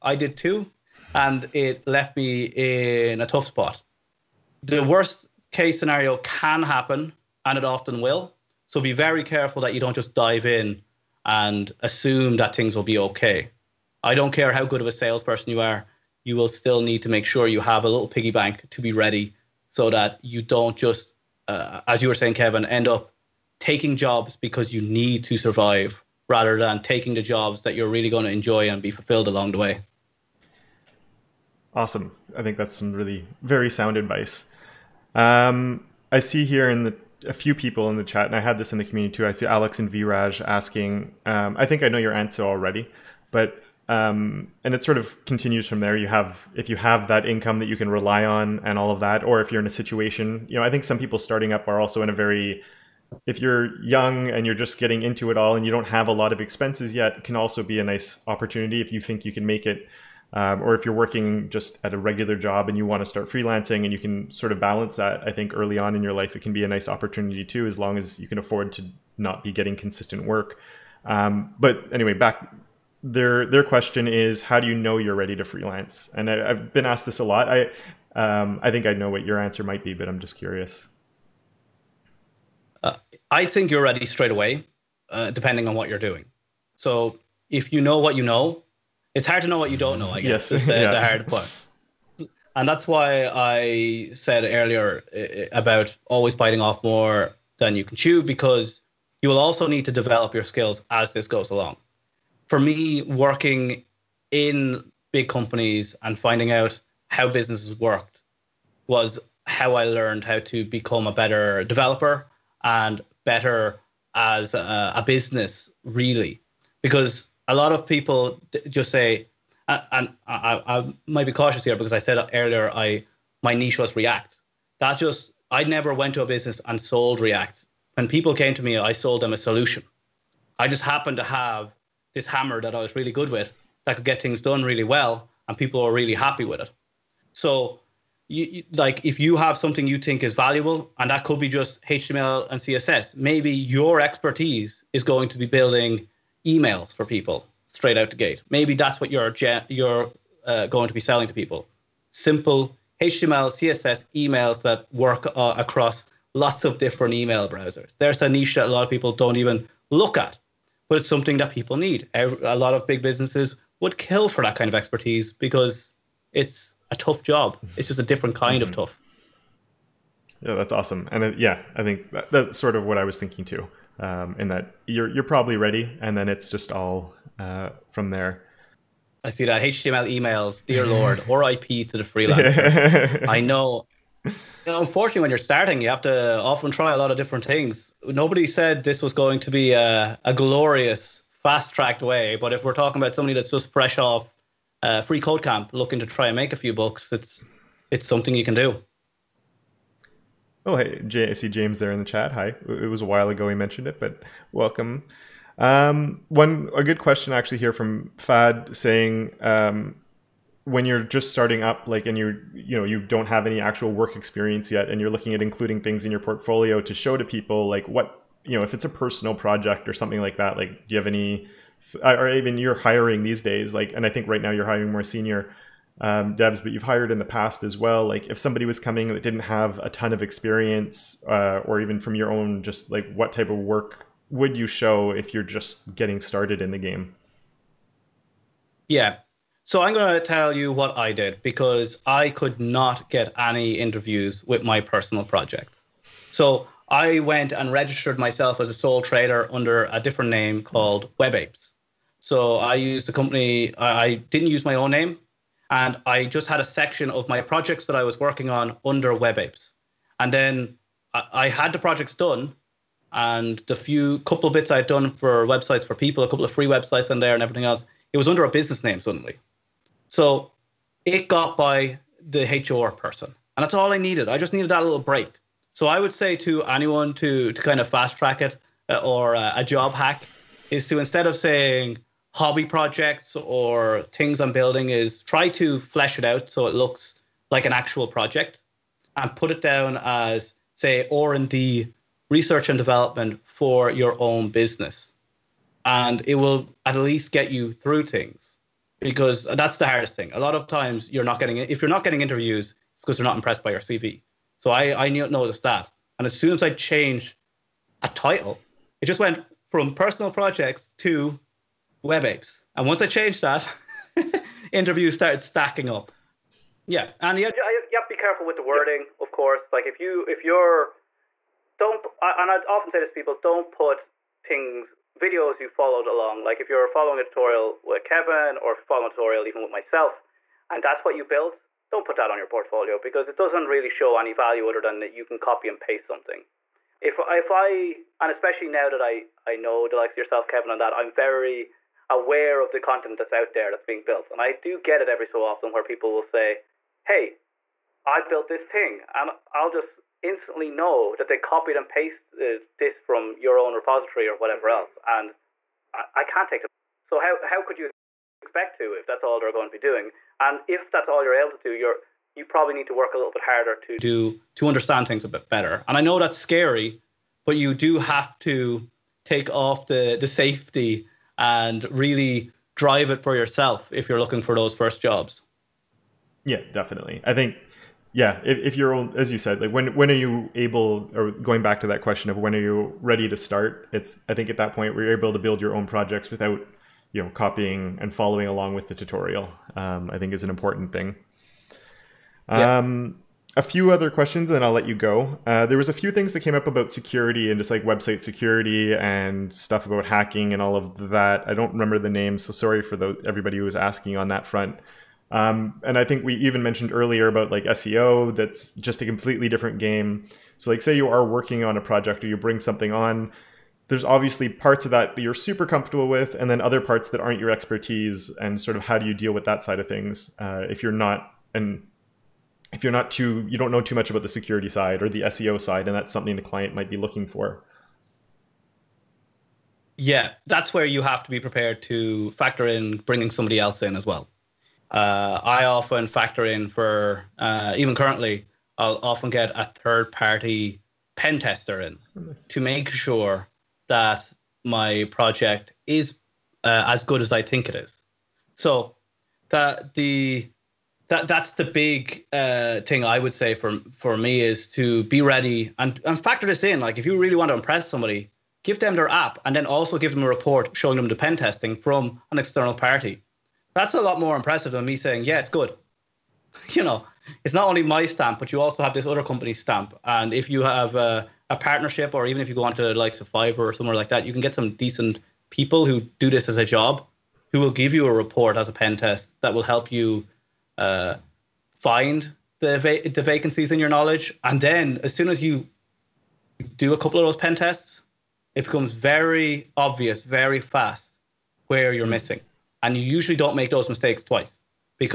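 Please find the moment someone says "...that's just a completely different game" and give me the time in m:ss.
6:48.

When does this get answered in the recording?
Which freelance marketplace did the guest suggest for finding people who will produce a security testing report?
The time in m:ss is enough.
7:53.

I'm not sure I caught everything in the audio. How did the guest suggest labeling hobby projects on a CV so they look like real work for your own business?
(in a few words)
R&D.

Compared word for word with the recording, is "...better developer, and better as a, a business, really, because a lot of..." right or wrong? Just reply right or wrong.
right.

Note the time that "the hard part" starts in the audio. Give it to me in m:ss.
1:30.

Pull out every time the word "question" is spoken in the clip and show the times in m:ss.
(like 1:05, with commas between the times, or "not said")
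1:13, 3:26, 6:22, 6:34.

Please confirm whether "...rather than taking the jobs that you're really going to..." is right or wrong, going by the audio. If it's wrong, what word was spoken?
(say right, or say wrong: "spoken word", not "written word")
right.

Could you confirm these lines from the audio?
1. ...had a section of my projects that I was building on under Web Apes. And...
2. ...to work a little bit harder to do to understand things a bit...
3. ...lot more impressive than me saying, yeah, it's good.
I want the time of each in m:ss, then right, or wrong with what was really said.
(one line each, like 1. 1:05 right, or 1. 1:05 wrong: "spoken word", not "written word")
1. 4:16 wrong: "working", not "building"
2. 6:02 right
3. 7:43 right.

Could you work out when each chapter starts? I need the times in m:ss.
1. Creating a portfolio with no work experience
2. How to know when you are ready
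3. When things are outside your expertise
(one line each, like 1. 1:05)
1. 2:33
2. 1:08
3. 5:31.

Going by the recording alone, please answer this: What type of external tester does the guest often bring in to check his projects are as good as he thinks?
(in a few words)
pen tester.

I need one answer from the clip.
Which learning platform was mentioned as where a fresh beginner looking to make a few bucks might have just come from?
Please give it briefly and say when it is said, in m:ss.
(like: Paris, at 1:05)
freeCodeCamp, at 3:15.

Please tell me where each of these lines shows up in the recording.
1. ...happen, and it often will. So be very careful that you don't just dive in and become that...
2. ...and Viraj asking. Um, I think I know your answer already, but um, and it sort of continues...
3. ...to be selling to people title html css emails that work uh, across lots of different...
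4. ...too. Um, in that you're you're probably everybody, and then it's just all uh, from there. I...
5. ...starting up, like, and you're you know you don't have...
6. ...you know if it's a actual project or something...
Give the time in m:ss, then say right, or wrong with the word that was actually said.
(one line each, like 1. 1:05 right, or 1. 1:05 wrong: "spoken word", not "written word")
1. 0:06 wrong: "assume", not "become"
2. 0:39 right
3. 2:30 wrong: "simple", not "title"
4. 2:53 wrong: "ready", not "everybody"
5. 3:31 right
6. 3:38 wrong: "personal", not "actual".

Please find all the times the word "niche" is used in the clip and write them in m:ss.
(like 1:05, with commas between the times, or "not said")
2:03, 2:38.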